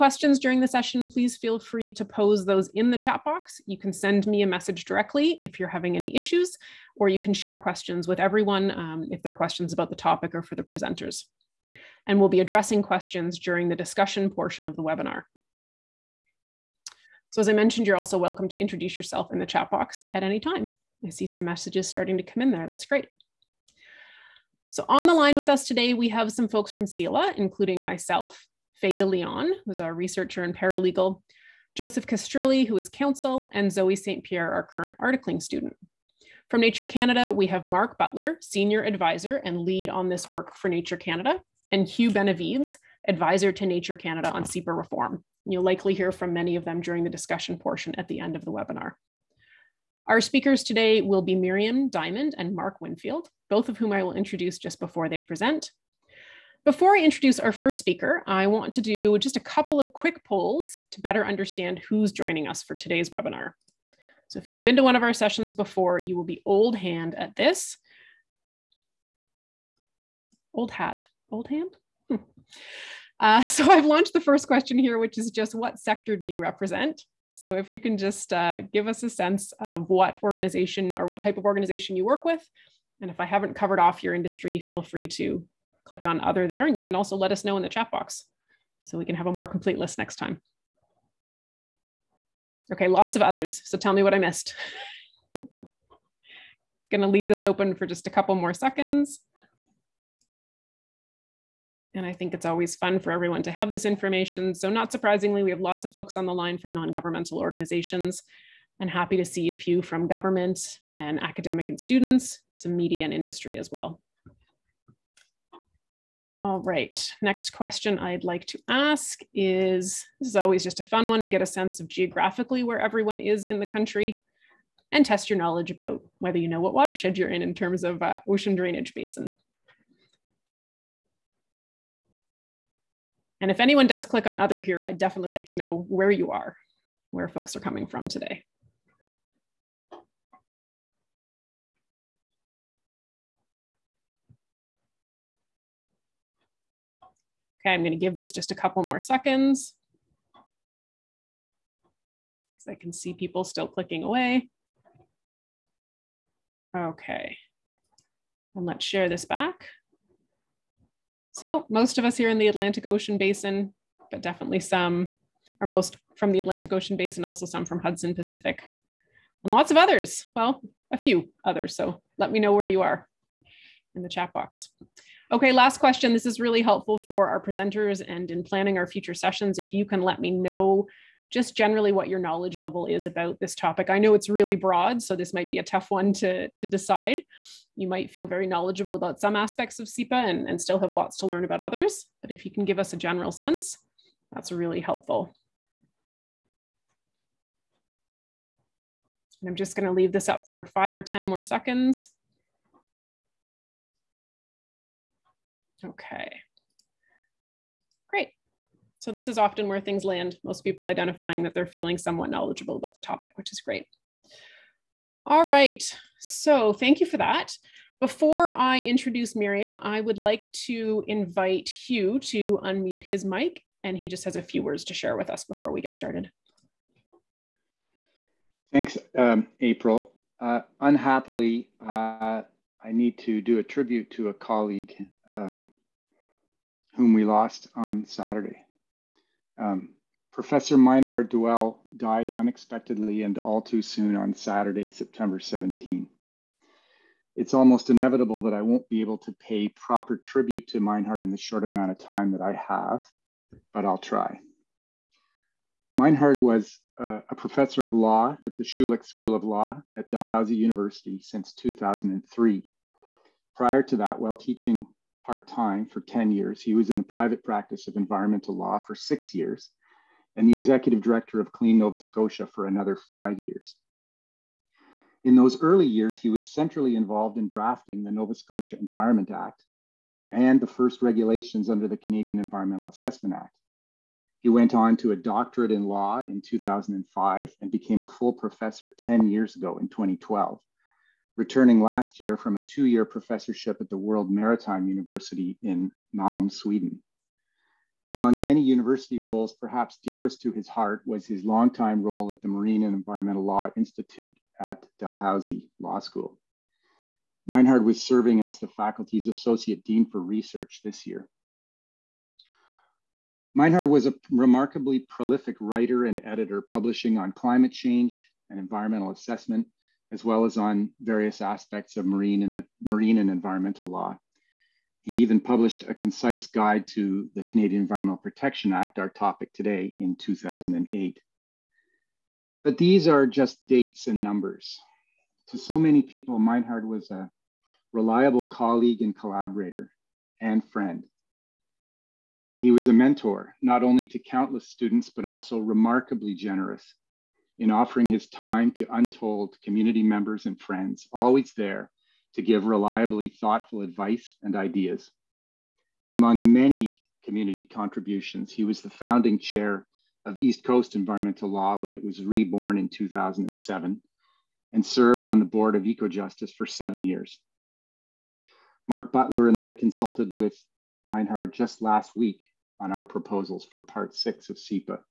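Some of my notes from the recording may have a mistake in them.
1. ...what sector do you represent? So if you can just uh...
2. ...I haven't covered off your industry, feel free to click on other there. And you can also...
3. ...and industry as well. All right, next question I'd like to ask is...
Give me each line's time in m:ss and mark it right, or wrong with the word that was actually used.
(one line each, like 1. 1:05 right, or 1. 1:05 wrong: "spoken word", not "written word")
1. 1:15 right
2. 1:23 right
3. 1:53 right.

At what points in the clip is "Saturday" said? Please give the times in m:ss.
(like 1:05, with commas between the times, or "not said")
3:58, 4:04.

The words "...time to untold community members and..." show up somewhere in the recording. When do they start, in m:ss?
5:48.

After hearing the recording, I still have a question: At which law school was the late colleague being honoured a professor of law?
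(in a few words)
Schulich School of Law.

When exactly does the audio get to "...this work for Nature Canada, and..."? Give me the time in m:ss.
0:40.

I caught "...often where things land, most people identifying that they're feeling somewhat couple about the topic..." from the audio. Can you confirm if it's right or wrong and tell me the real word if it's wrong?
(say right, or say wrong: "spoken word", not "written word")
wrong: "knowledgeable", not "couple".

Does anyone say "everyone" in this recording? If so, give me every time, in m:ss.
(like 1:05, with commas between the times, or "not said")
0:08, 1:43, 2:02.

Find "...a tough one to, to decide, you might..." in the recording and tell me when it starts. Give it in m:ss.
3:05.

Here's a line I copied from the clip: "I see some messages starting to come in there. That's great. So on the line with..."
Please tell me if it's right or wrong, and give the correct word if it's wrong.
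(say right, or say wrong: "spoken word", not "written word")
right.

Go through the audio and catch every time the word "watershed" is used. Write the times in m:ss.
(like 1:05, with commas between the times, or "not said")
2:06.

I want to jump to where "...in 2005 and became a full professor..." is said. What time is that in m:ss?
4:46.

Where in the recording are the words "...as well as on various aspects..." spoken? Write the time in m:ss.
5:20.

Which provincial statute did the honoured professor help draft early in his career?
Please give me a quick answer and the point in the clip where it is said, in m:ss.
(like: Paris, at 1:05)
Nova Scotia Environment Act, at 4:38.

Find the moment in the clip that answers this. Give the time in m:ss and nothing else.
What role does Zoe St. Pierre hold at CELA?
0:34.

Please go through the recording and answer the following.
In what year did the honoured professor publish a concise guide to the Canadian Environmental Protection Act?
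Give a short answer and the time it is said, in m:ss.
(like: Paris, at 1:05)
2008, at 5:30.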